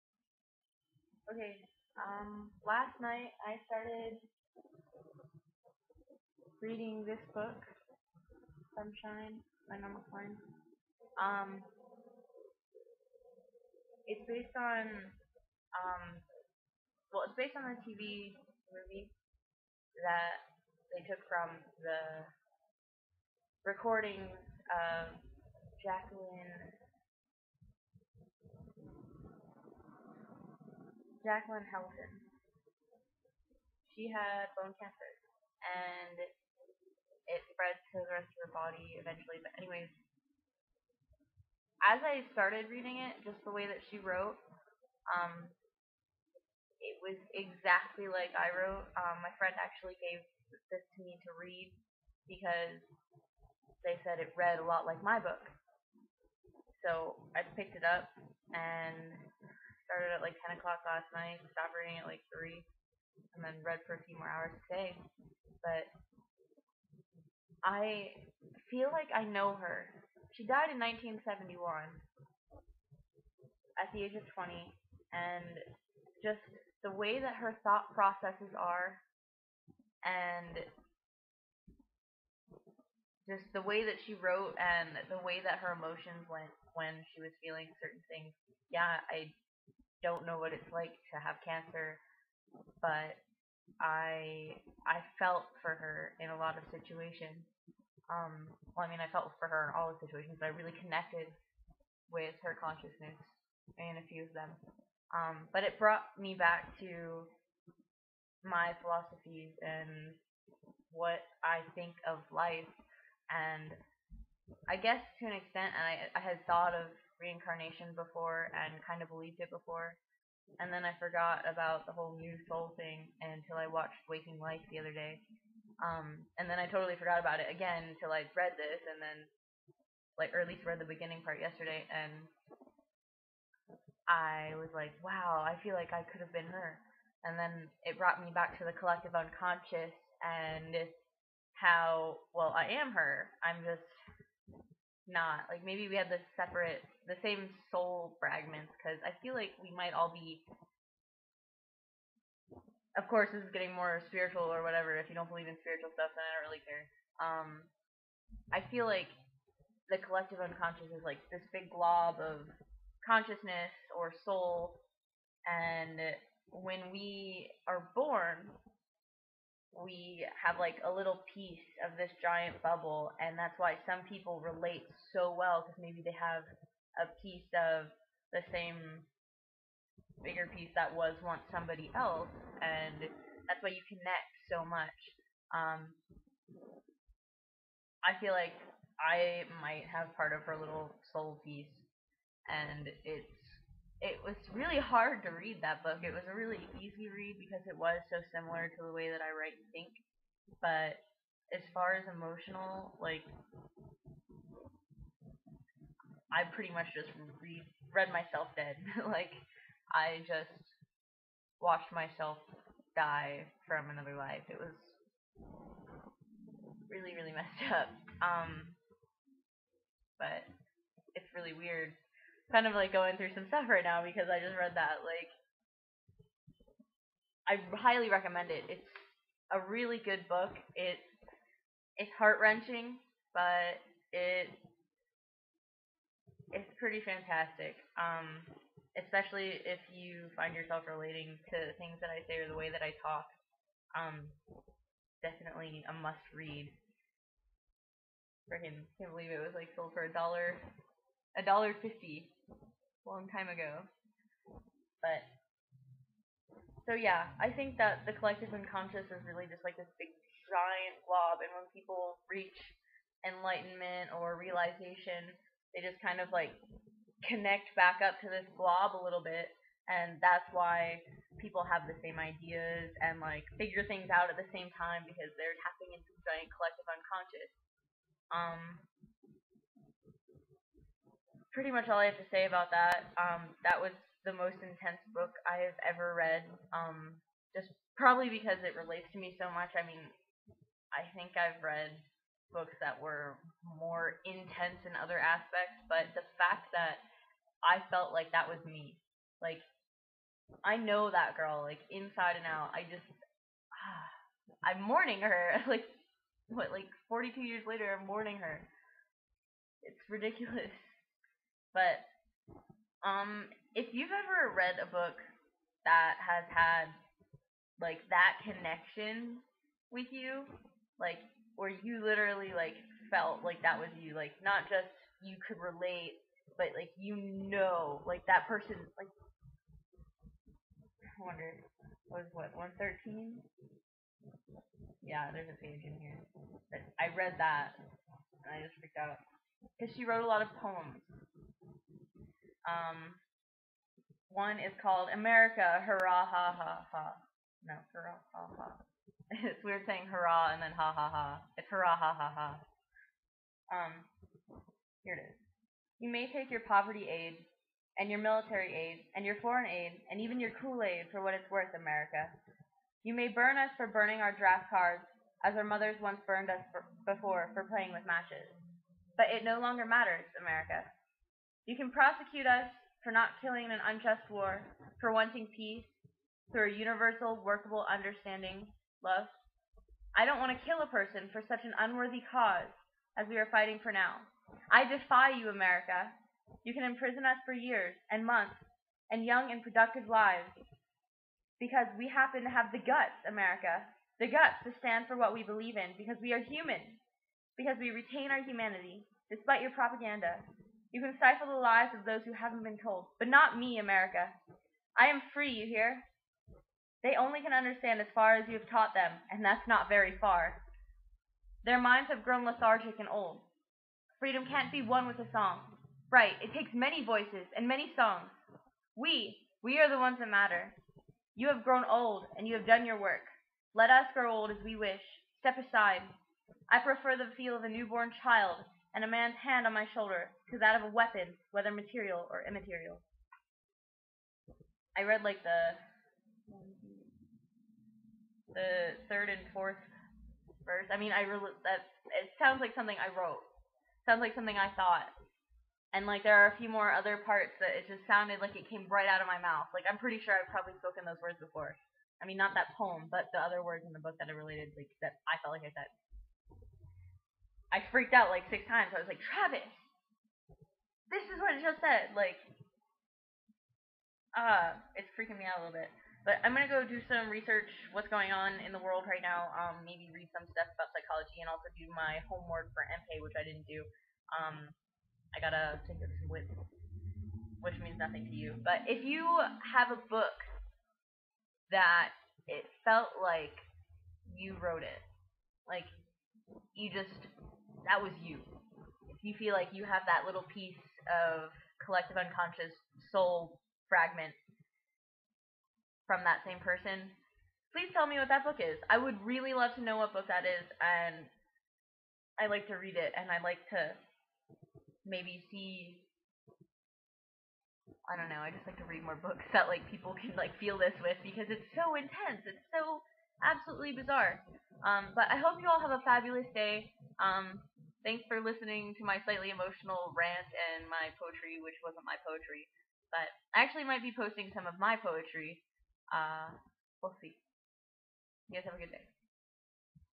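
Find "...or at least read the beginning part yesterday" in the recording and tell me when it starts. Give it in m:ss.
2:10.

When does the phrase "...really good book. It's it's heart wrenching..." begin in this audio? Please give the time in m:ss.
3:49.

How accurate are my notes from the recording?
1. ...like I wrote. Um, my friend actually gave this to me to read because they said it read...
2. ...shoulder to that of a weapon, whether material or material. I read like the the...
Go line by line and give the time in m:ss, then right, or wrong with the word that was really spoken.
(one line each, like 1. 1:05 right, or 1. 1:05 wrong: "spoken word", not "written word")
1. 0:48 right
2. 7:09 wrong: "immaterial", not "material".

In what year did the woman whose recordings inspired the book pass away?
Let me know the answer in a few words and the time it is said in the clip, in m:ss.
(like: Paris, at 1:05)
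1971, at 1:10.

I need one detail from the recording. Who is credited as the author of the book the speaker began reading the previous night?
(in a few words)
Norma Klein.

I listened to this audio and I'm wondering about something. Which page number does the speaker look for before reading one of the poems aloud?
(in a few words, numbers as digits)
113.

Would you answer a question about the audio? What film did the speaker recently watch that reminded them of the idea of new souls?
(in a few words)
Waking Life.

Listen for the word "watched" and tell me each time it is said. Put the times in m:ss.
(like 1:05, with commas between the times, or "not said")
2:03, 3:31.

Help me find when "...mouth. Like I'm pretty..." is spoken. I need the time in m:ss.
7:29.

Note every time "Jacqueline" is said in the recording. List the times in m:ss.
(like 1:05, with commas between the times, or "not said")
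0:25, 0:31.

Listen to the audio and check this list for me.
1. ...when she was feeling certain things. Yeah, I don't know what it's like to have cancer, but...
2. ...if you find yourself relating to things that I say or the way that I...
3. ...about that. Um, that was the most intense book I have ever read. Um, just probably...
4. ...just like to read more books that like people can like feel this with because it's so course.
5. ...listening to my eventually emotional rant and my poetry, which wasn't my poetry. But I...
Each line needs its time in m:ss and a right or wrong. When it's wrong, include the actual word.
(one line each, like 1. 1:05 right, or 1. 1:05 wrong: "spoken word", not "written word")
1. 1:26 right
2. 3:59 right
3. 4:42 right
4. 8:28 wrong: "intense", not "course"
5. 8:38 wrong: "slightly", not "eventually".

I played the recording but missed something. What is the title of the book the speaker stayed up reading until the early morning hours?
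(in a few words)
Sunshine.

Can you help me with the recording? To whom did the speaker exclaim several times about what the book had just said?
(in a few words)
Travis.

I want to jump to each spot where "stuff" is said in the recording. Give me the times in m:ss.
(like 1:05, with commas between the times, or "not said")
2:35, 3:43, 7:50.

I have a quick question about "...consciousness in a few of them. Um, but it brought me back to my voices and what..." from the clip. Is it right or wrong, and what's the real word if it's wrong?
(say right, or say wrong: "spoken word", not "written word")
wrong: "philosophies", not "voices".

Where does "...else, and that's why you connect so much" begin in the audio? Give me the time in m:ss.
3:01.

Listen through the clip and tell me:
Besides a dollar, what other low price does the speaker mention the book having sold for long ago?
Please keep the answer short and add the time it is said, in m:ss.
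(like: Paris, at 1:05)
$1.50, at 4:11.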